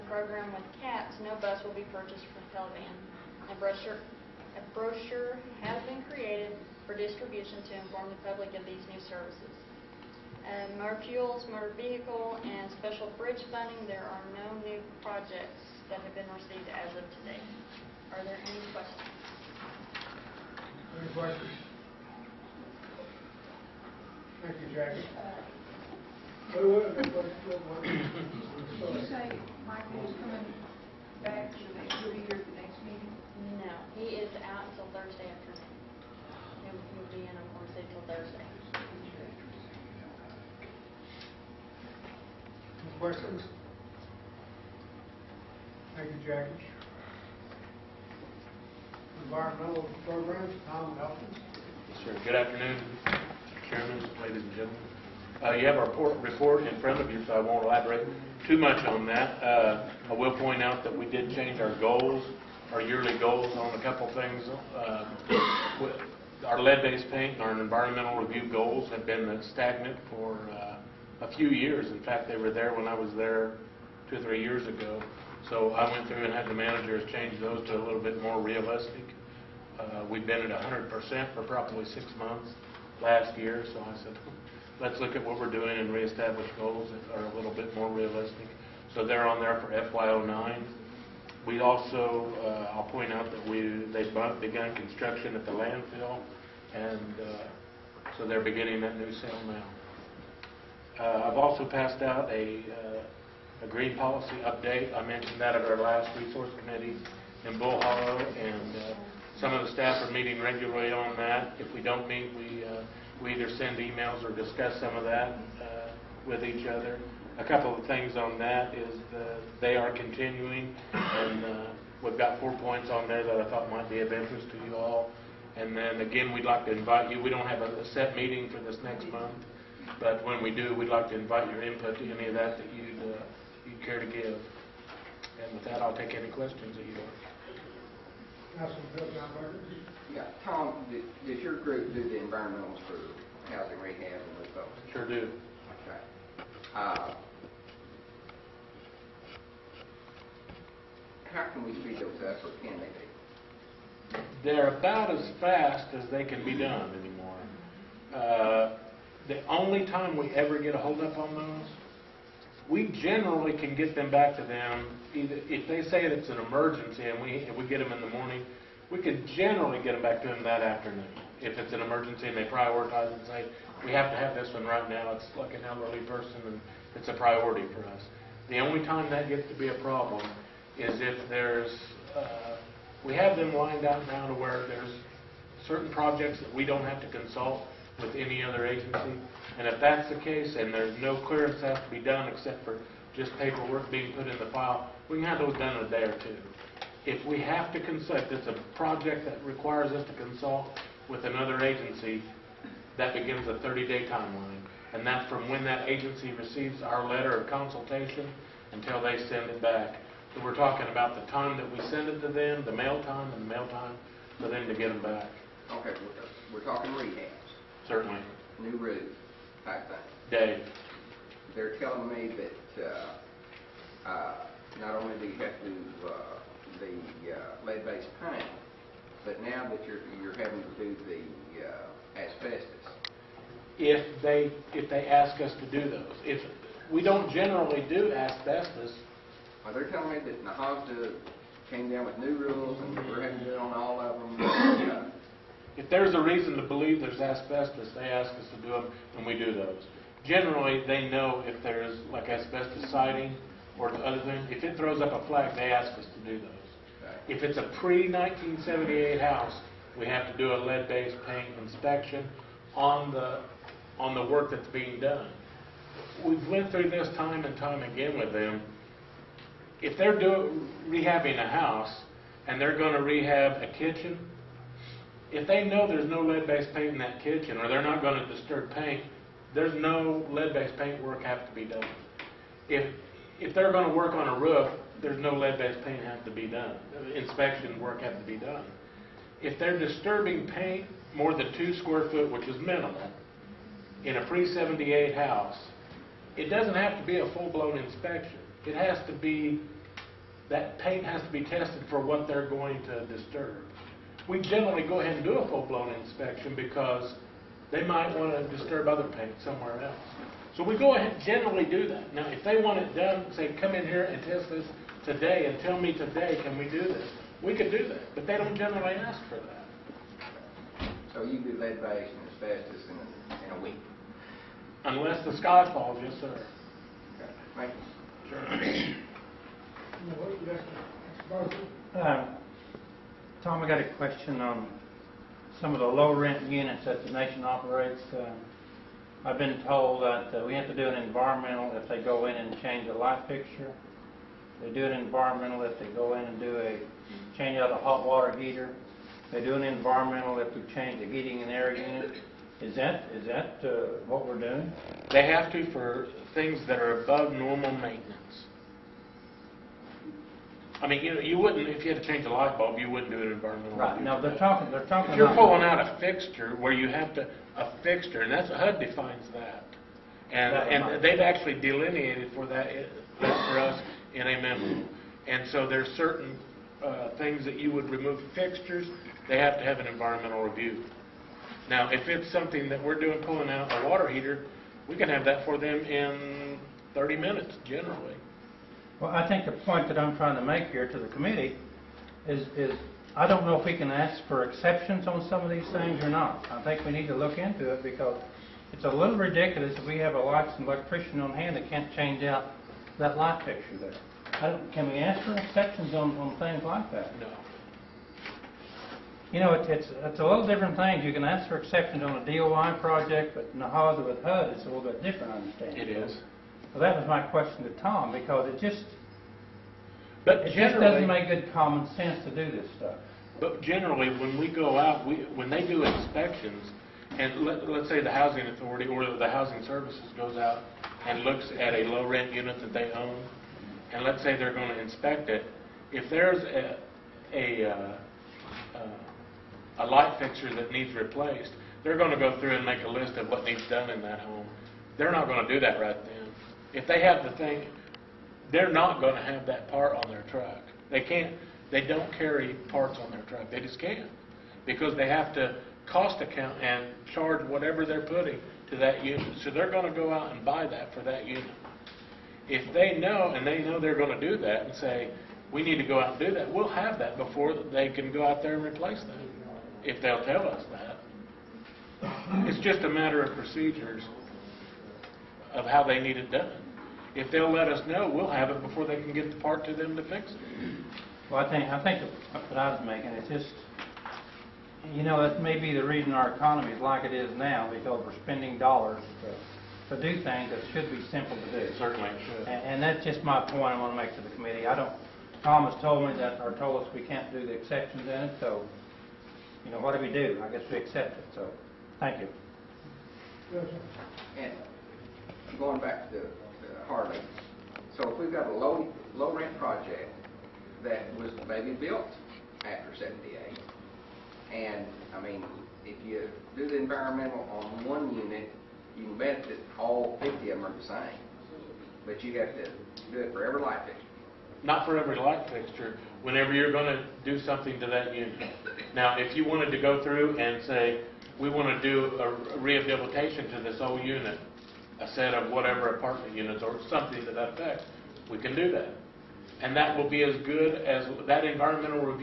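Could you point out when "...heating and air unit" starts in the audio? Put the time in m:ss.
5:51.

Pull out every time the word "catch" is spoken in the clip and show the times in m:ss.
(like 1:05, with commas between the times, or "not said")
not said.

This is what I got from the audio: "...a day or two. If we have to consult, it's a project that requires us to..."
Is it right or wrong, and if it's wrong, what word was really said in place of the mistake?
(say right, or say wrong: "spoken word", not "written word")
right.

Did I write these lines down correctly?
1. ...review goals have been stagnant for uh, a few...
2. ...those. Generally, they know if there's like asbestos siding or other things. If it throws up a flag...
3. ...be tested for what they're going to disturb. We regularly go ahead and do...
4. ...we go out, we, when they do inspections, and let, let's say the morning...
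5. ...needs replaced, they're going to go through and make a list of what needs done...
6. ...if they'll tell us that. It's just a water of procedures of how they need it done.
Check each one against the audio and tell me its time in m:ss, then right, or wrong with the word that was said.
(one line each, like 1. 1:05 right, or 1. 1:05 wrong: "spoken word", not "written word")
1. 1:08 right
2. 4:09 right
3. 5:01 wrong: "generally", not "regularly"
4. 7:04 wrong: "housing", not "morning"
5. 7:20 right
6. 7:49 wrong: "matter", not "water".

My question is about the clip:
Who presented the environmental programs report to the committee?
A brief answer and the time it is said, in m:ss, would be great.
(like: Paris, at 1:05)
Tom Elkins, at 0:50.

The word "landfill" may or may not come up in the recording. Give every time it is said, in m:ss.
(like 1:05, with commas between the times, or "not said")
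1:35.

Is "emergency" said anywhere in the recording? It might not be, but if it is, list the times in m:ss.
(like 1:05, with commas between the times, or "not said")
2:46, 2:51.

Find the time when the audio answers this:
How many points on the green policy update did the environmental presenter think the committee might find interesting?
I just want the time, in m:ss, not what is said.
2:02.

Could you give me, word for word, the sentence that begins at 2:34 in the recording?
They're about as fast as they can be done anymore.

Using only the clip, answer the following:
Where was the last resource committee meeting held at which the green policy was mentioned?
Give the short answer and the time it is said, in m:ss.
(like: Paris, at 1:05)
Bull Hollow, at 1:47.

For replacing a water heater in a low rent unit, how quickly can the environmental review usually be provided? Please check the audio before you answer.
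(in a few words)
30 minutes.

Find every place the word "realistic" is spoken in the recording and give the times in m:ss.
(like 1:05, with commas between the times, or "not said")
1:18, 1:27.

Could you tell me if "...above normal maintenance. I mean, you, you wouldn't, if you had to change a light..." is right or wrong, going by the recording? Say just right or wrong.
right.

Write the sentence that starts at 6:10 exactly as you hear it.
And, That and they've actually delineated for that, for us in a memo.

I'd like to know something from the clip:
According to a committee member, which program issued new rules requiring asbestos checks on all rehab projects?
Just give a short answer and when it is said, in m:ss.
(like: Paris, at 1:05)
NAHASDA, at 4:00.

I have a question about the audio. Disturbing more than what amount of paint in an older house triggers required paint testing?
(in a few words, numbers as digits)
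2 square feet.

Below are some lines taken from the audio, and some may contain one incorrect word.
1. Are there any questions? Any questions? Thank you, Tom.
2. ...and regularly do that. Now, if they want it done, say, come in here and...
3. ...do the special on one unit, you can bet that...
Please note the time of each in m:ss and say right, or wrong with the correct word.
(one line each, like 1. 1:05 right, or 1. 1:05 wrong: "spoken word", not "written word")
1. 0:18 wrong: "Jackie", not "Tom"
2. 5:11 wrong: "generally", not "regularly"
3. 8:36 wrong: "environmental", not "special".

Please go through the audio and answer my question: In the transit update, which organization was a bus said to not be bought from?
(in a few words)
Pelivan.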